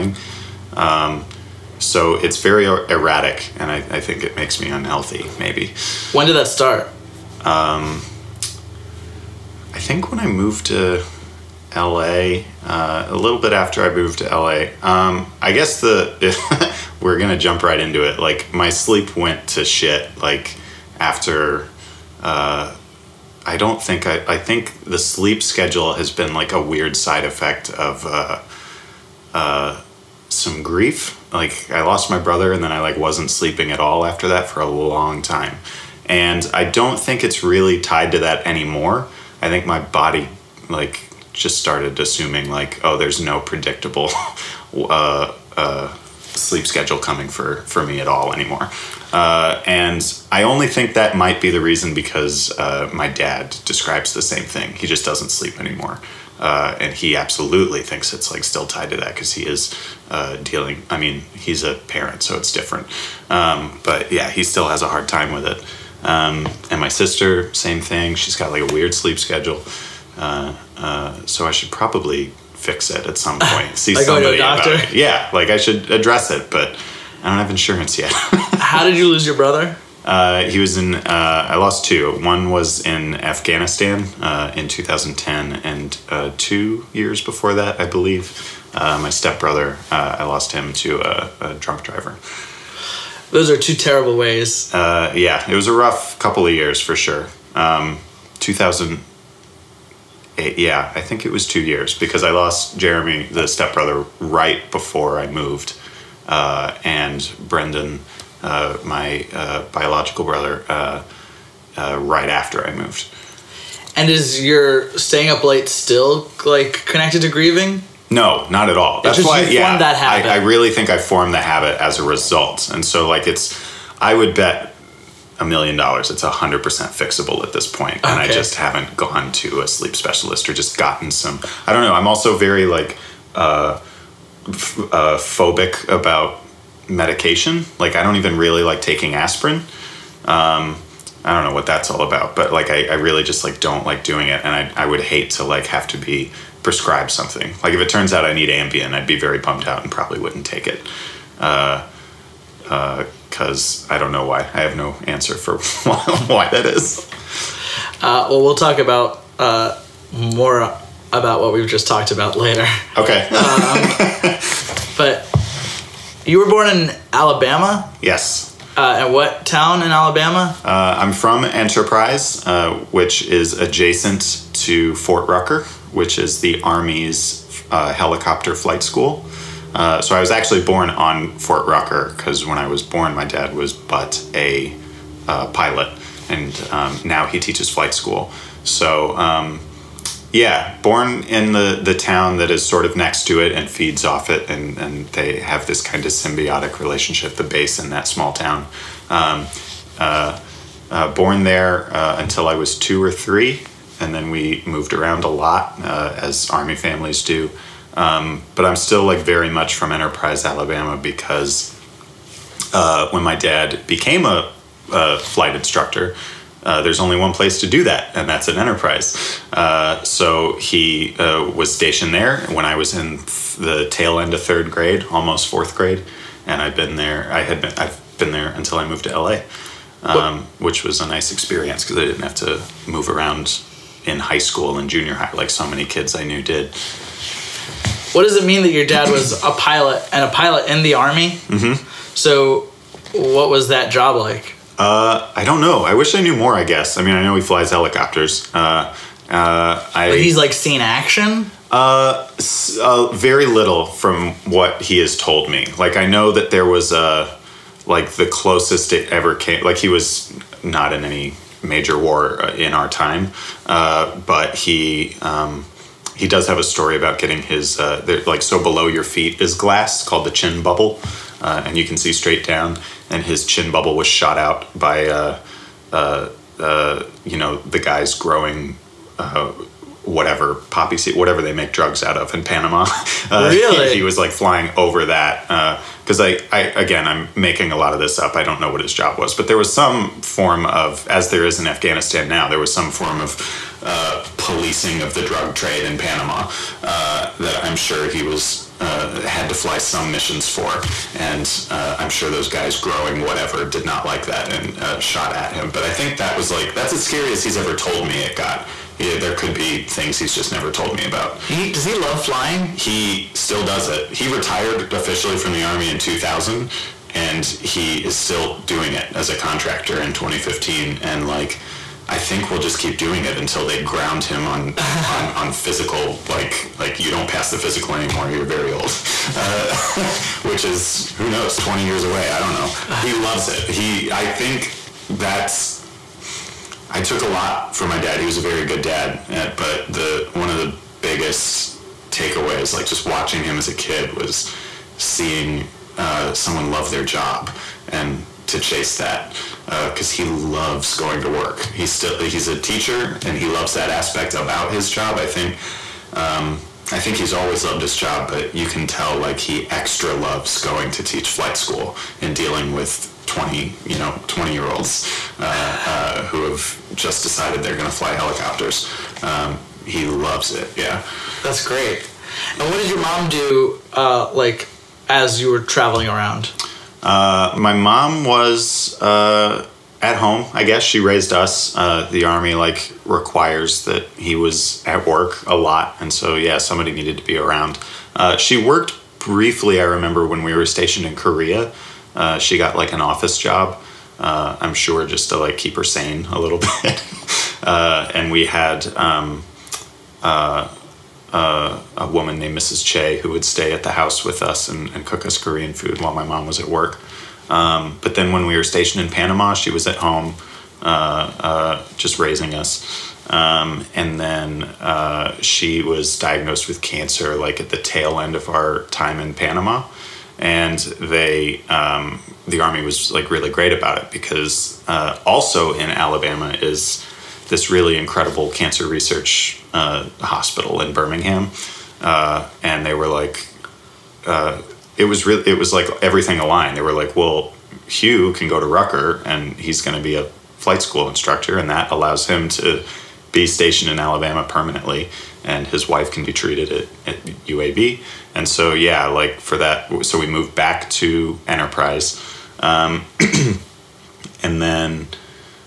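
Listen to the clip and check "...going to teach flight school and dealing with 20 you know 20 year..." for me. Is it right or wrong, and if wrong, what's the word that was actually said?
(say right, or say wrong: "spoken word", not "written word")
right.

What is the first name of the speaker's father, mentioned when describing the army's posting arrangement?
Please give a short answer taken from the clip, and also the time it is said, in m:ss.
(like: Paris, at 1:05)
Hugh, at 7:17.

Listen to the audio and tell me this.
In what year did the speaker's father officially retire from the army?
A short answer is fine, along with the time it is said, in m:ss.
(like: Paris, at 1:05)
2000, at 5:15.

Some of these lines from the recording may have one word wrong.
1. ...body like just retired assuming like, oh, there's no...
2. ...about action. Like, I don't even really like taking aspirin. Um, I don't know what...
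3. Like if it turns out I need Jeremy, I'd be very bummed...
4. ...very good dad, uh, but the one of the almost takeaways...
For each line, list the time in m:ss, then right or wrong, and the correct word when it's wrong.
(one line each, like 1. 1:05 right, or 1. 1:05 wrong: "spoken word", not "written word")
1. 0:39 wrong: "started", not "retired"
2. 2:15 wrong: "medication", not "action"
3. 2:27 wrong: "Ambien", not "Jeremy"
4. 5:38 wrong: "biggest", not "almost".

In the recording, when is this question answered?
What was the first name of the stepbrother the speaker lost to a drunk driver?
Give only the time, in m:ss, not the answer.
1:42.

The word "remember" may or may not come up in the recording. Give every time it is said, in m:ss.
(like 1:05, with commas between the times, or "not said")
6:29.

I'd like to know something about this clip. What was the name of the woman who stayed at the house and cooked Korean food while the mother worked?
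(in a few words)
Mrs. Che.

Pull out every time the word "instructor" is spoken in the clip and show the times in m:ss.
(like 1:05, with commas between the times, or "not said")
3:35, 7:21.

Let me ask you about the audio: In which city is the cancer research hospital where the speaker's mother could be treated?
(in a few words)
Birmingham.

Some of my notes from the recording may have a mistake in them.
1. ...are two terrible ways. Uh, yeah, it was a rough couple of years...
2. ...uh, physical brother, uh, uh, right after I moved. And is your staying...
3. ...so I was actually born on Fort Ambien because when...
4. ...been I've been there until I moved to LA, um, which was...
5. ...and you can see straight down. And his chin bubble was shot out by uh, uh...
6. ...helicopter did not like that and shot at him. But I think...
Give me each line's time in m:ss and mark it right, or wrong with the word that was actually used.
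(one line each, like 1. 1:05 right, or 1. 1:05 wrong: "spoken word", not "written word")
1. 1:33 right
2. 1:49 wrong: "biological", not "physical"
3. 3:00 wrong: "Rucker", not "Ambien"
4. 3:47 right
5. 4:31 right
6. 5:03 wrong: "whatever", not "helicopter".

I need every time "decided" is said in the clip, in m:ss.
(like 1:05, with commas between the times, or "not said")
6:07.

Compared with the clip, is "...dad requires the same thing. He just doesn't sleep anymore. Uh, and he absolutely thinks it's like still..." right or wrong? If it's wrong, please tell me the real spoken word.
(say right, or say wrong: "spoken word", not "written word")
wrong: "describes", not "requires".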